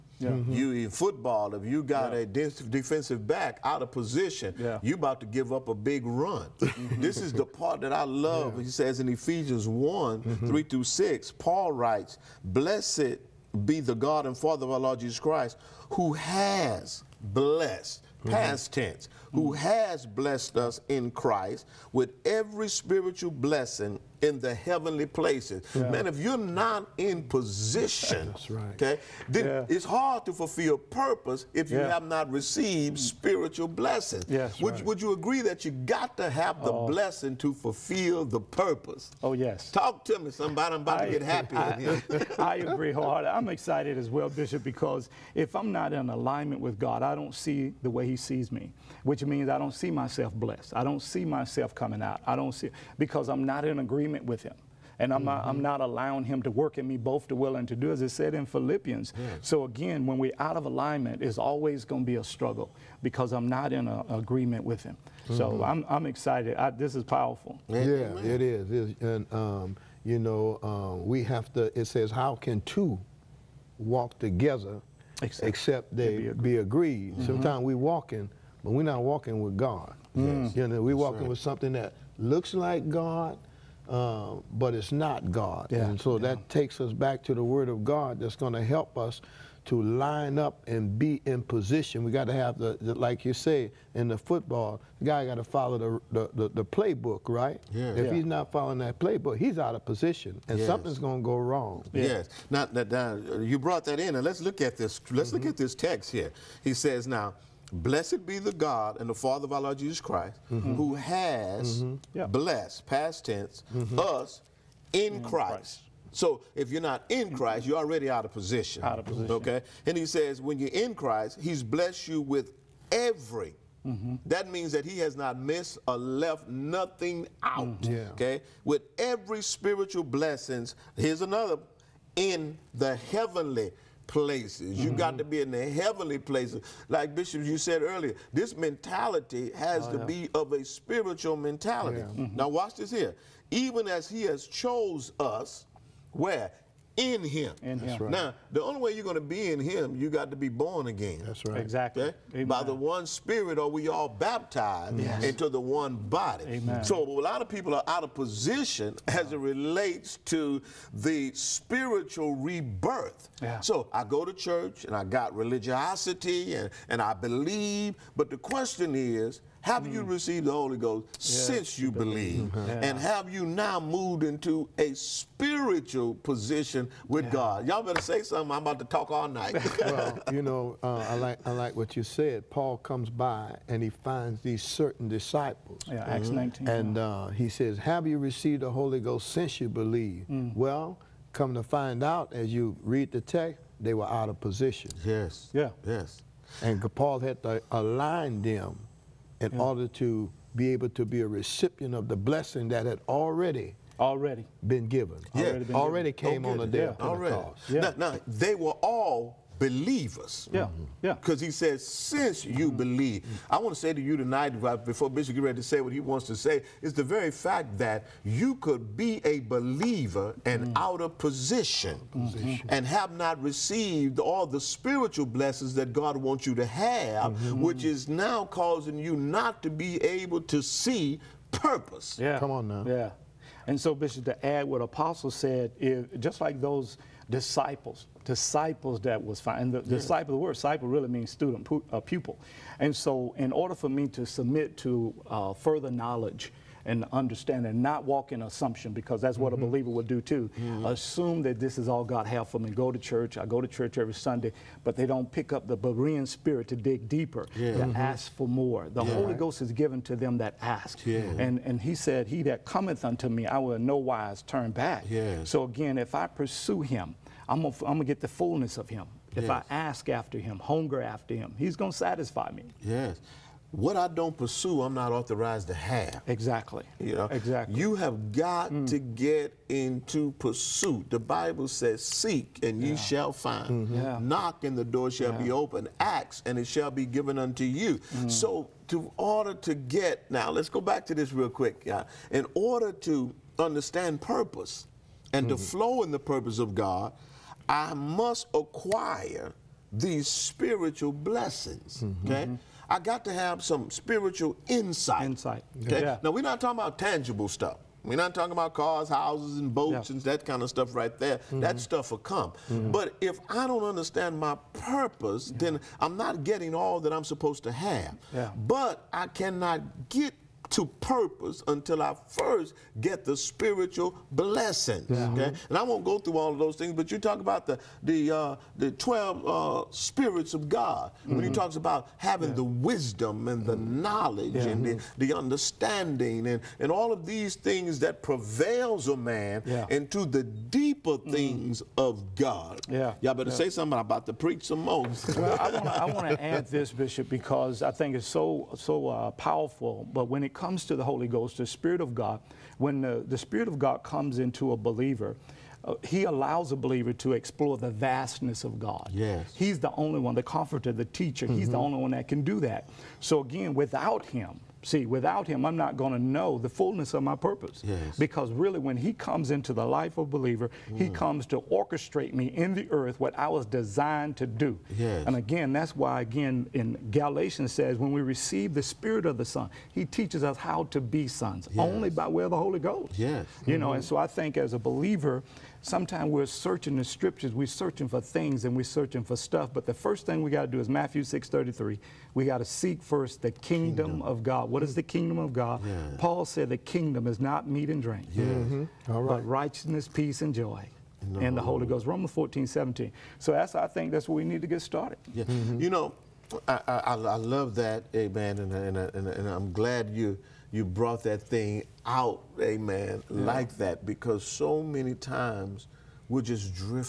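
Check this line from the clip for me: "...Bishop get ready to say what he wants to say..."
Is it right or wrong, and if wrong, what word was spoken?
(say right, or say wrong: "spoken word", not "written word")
right.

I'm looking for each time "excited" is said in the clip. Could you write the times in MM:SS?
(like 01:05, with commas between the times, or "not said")
00:43, 01:06.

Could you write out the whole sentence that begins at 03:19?
order to be able to be a recipient of the blessing that had already already been given.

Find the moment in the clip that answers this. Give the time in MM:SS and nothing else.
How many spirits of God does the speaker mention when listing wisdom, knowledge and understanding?
05:28.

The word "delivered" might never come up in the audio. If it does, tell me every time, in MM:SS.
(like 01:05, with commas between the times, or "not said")
not said.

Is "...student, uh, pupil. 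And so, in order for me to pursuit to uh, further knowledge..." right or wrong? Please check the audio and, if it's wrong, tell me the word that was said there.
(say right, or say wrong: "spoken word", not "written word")
wrong: "submit", not "pursuit".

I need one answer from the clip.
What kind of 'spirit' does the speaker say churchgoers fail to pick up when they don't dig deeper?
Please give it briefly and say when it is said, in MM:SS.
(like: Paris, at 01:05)
Berean spirit, at 04:15.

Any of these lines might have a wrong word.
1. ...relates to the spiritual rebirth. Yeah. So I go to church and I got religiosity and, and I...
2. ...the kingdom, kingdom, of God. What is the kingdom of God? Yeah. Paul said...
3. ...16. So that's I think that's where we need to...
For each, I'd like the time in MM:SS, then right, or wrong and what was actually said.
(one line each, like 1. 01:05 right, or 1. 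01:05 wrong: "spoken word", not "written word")
1. 02:39 right
2. 06:33 right
3. 06:42 wrong: "17", not "16".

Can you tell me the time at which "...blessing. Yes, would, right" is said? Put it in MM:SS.
00:33.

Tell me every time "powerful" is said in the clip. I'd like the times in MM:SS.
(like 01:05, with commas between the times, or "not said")
01:07, 05:49.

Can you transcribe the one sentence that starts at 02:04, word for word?
That means that he has not missed or left nothing out.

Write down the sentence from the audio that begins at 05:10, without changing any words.
and that kind of stuff right there.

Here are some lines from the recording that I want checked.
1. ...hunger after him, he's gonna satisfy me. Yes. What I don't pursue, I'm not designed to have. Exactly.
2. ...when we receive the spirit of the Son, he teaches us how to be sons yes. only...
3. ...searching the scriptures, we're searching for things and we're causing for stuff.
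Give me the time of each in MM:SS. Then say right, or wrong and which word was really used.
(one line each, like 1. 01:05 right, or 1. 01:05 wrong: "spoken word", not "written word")
1. 04:30 wrong: "authorized", not "designed"
2. 06:17 right
3. 06:26 wrong: "searching", not "causing".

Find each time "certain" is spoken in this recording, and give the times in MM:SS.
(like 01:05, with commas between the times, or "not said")
03:04.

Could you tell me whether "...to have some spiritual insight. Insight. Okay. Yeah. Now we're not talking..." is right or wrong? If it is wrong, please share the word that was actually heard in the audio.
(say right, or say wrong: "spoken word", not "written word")
right.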